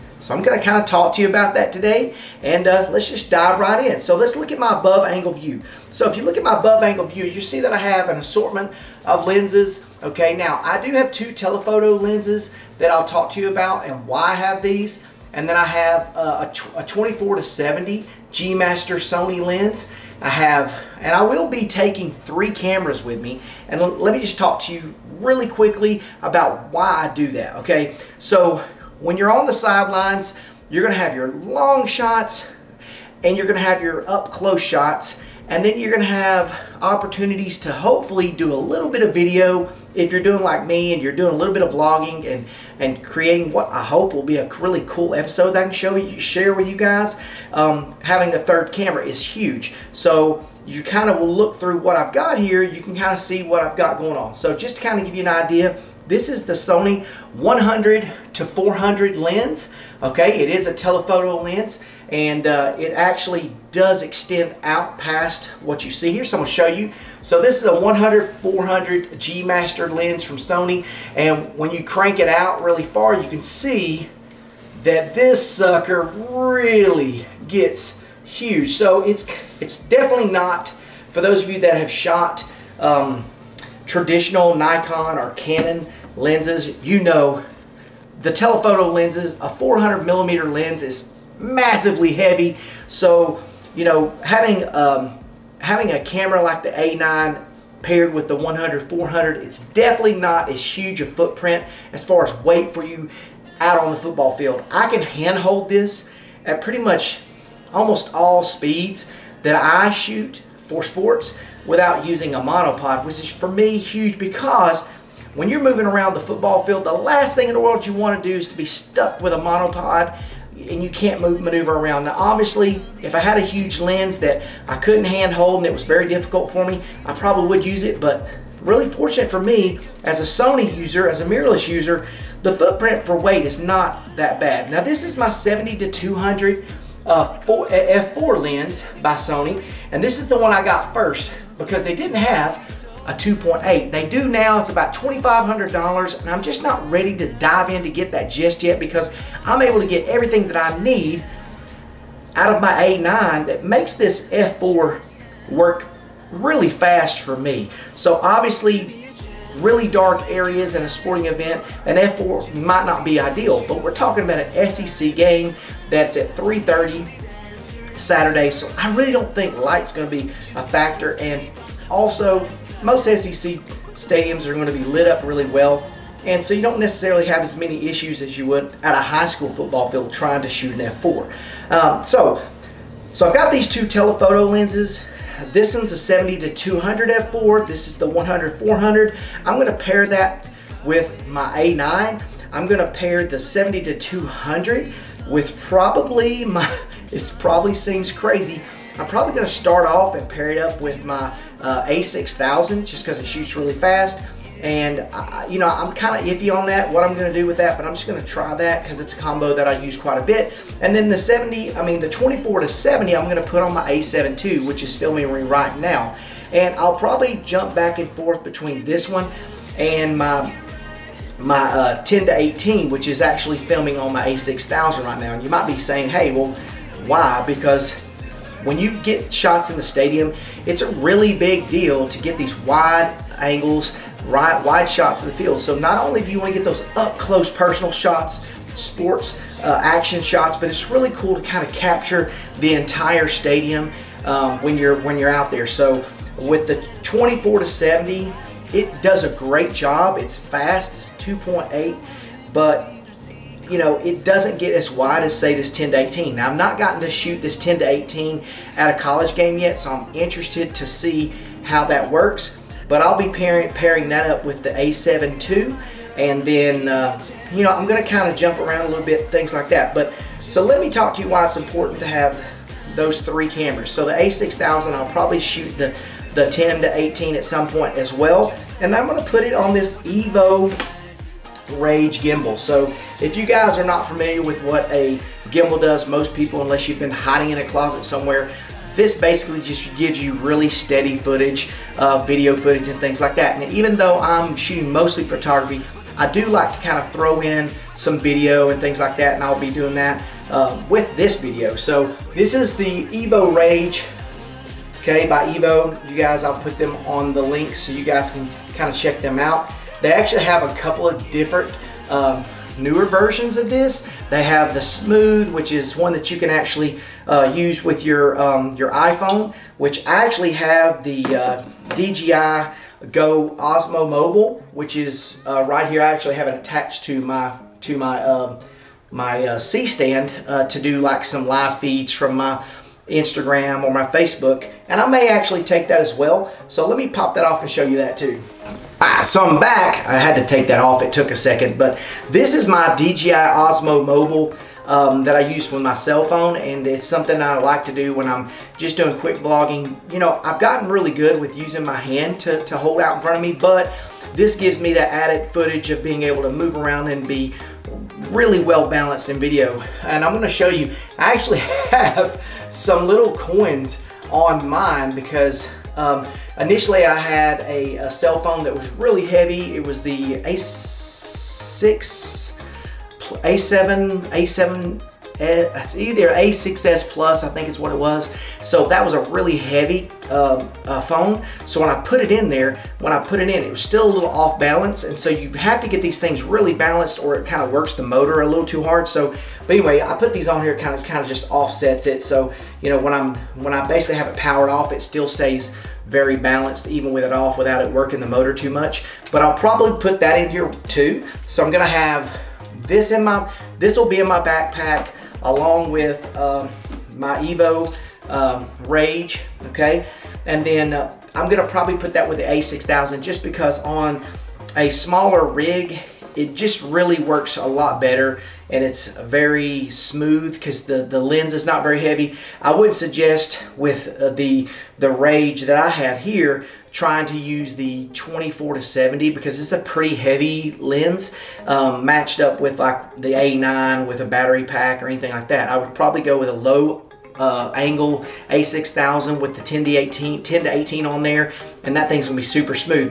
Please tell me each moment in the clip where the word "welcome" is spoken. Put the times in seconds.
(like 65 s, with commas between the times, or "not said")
not said.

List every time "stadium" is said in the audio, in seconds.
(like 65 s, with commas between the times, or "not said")
173 s, 229 s, 243 s.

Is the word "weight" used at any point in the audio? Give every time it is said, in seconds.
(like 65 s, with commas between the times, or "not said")
102 s, 133 s.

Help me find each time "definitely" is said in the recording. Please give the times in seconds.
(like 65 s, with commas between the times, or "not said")
79 s, 99 s.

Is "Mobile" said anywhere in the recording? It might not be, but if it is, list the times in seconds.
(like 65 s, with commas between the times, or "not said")
324 s, 344 s.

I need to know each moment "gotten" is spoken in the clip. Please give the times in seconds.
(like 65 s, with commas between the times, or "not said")
256 s, 350 s.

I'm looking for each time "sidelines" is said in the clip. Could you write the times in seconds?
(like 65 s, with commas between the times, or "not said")
29 s.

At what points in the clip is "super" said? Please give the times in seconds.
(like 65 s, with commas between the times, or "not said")
442 s.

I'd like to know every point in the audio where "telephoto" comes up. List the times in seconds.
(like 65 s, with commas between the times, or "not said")
11 s, 60 s, 88 s, 183 s.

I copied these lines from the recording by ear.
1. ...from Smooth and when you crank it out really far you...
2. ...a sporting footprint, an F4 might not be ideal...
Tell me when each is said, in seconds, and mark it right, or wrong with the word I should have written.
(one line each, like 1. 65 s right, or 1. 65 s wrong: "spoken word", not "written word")
1. 70 s wrong: "Sony", not "Smooth"
2. 160 s wrong: "event", not "footprint".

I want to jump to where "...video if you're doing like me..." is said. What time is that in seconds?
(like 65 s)
39 s.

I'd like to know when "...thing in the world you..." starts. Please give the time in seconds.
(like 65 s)
117 s.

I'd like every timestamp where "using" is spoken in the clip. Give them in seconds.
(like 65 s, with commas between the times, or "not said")
112 s, 351 s.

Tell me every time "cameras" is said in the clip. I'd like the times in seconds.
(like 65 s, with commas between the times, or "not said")
22 s, 48 s, 96 s, 273 s.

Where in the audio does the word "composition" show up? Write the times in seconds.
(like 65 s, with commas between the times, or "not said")
not said.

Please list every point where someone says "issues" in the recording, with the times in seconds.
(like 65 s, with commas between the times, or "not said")
177 s.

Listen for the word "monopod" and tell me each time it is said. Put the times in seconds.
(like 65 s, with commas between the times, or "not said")
112 s, 119 s.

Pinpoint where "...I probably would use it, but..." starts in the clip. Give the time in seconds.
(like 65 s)
127 s.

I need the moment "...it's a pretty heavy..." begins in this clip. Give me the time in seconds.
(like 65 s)
429 s.